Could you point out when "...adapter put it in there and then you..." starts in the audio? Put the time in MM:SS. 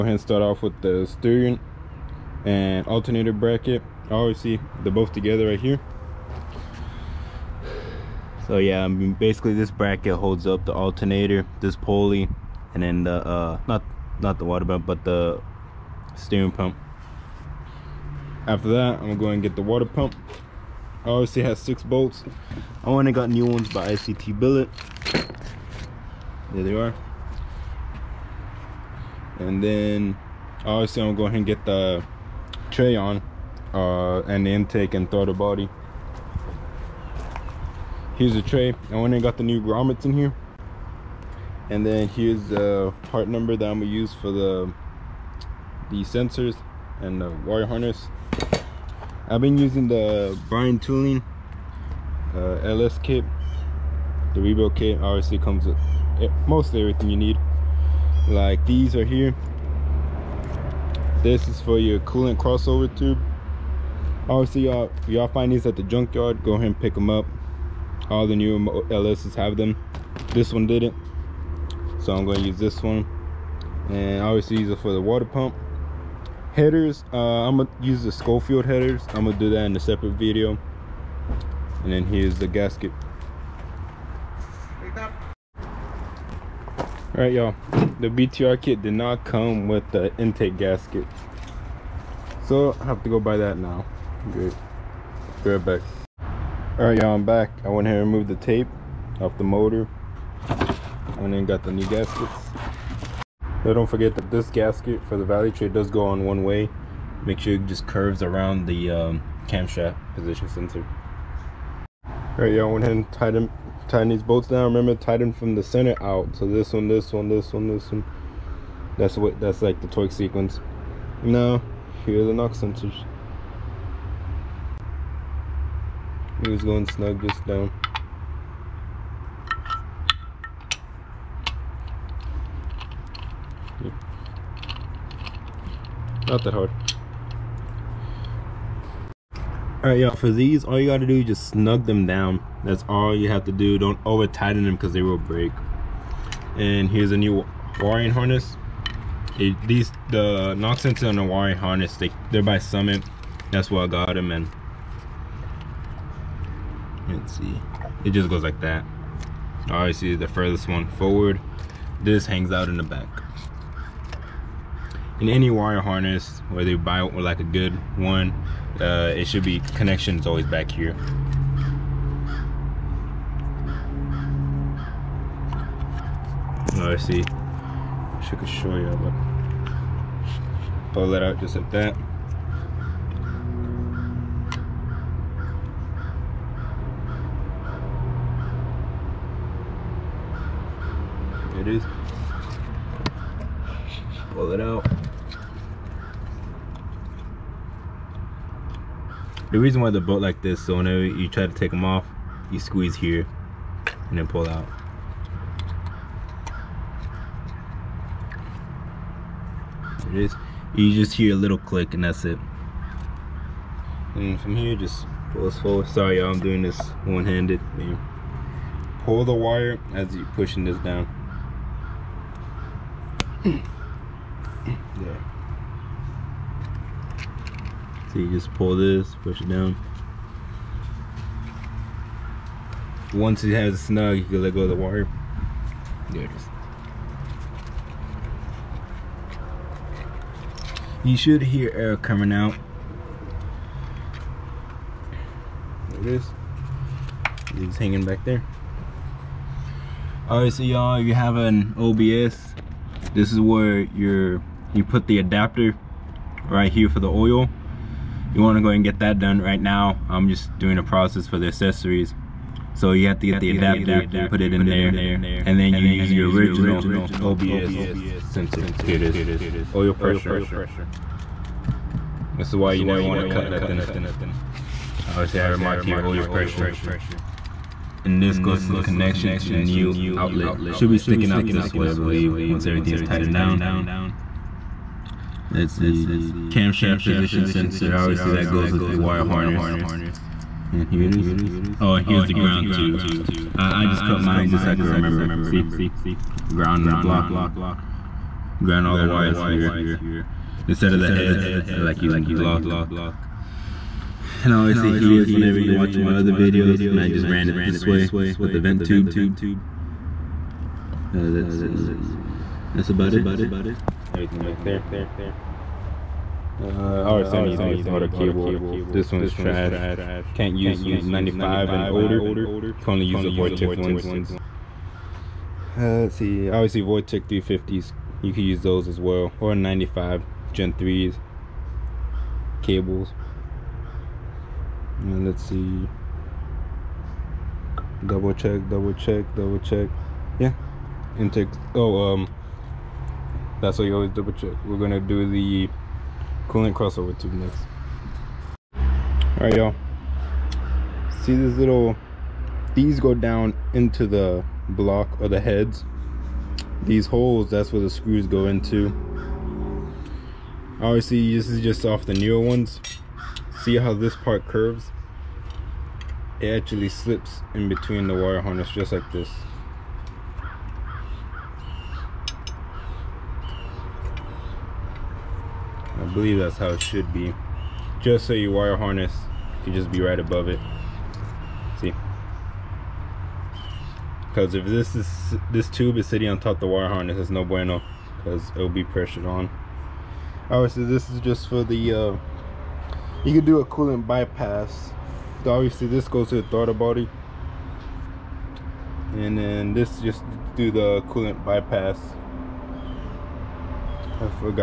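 04:23.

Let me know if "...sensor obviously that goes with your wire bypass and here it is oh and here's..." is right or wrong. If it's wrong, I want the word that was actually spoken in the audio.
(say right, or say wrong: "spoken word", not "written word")
wrong: "harness", not "bypass".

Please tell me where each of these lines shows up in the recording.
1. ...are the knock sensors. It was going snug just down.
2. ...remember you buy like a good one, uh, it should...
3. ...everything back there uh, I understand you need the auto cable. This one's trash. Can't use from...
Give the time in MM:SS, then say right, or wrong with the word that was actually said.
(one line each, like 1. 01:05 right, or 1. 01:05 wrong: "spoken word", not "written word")
1. 02:02 right
2. 02:46 wrong: "whether", not "remember"
3. 05:14 right.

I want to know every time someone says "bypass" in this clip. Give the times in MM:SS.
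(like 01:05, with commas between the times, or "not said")
06:34, 06:41.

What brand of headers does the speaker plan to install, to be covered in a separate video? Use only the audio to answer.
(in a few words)
Schofield.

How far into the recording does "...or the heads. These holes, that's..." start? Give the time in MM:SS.
05:55.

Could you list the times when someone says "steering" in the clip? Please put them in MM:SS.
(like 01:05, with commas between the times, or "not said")
00:01, 00:16.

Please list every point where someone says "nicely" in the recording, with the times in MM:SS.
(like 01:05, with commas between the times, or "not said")
not said.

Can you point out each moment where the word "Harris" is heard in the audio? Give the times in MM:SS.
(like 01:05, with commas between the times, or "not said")
not said.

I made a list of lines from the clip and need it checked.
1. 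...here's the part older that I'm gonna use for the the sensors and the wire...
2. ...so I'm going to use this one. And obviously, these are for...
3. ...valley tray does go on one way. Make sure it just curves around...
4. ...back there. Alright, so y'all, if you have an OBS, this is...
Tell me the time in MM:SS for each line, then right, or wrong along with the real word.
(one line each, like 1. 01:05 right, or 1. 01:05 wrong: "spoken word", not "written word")
1. 00:42 wrong: "number", not "older"
2. 01:12 right
3. 01:45 right
4. 04:08 right.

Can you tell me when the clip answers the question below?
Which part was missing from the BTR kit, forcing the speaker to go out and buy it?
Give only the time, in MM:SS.
01:30.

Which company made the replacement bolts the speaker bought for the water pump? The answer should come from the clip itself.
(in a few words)
ICT Billet.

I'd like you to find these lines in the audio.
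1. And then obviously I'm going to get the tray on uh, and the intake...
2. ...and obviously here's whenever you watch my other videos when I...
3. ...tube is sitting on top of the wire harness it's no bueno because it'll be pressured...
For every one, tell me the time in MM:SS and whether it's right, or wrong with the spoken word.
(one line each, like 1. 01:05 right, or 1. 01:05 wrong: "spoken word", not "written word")
1. 00:29 right
2. 05:04 right
3. 06:25 right.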